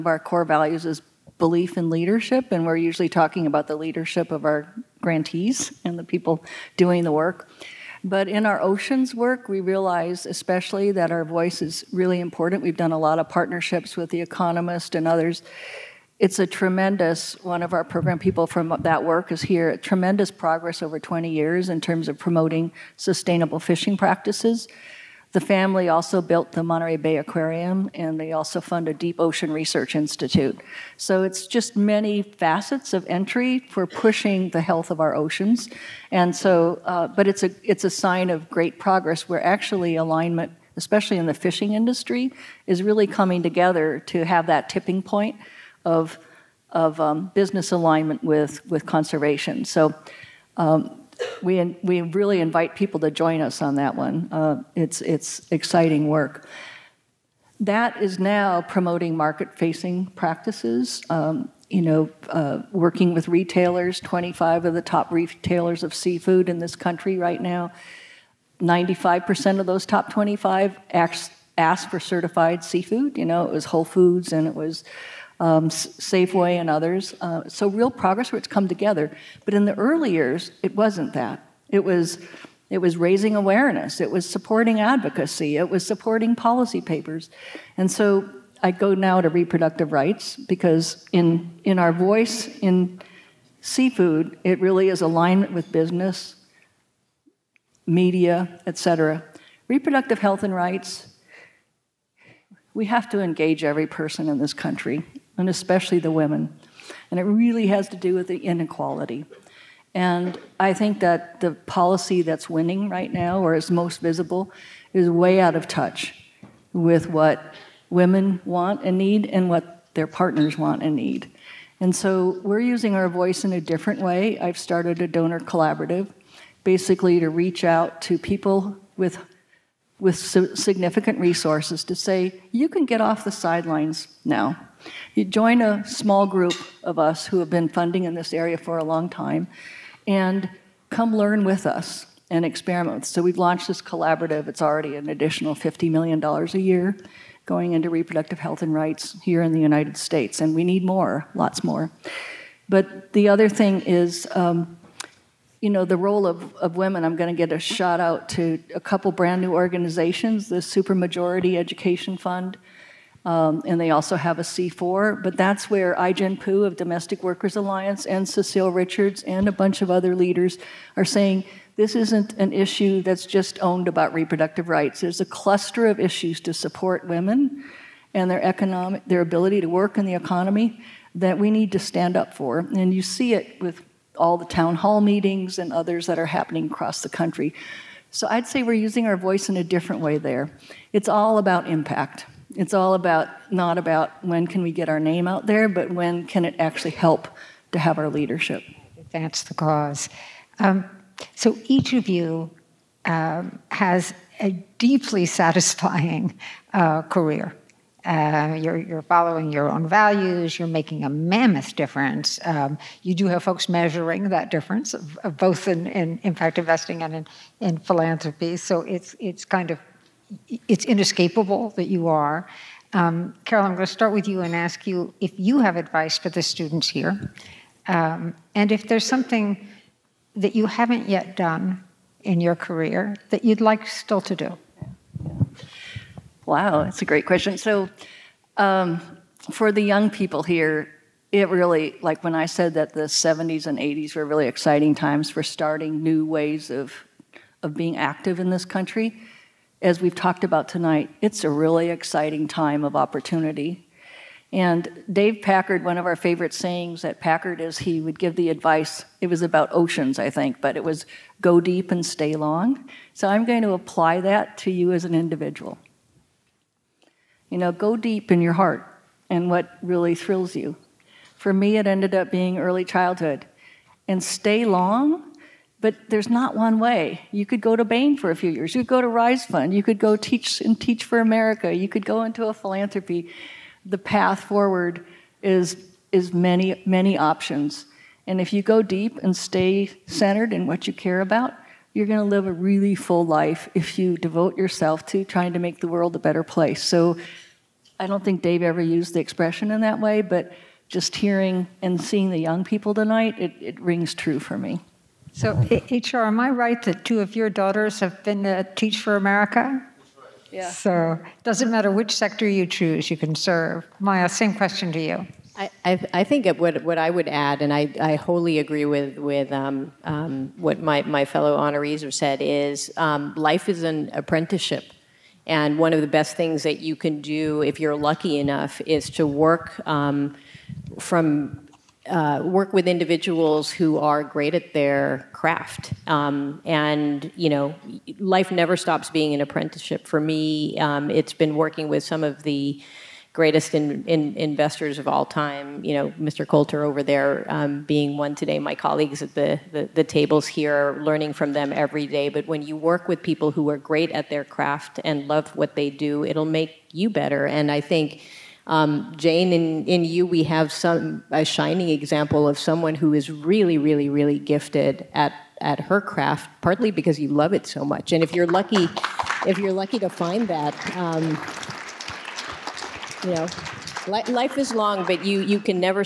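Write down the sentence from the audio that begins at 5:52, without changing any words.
But when you work with people who are great at their craft and love what they do, it'll make you better.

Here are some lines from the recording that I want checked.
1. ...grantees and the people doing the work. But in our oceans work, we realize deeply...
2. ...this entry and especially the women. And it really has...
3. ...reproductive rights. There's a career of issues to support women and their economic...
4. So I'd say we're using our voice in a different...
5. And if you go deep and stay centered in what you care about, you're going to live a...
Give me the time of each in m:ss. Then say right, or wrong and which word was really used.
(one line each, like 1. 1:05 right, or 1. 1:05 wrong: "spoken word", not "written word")
1. 0:04 wrong: "especially", not "deeply"
2. 1:44 wrong: "country", not "entry"
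3. 2:54 wrong: "cluster", not "career"
4. 3:08 right
5. 4:48 right.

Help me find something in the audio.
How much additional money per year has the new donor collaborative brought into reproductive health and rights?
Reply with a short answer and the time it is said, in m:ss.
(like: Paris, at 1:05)
$50 million, at 2:25.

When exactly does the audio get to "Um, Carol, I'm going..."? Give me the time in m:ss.
3:42.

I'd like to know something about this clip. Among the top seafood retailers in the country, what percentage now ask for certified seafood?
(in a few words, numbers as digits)
95%.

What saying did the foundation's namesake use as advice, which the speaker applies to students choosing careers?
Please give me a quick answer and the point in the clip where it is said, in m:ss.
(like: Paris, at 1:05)
Go deep and stay long, at 4:21.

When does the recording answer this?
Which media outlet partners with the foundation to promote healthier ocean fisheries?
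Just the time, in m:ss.
0:14.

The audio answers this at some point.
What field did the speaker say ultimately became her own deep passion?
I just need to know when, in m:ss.
4:32.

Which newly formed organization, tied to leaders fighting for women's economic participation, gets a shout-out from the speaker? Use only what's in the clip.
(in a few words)
Supermajority Education Fund.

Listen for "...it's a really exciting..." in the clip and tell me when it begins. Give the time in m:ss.
4:11.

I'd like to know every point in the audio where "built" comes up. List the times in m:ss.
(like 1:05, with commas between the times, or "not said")
0:26.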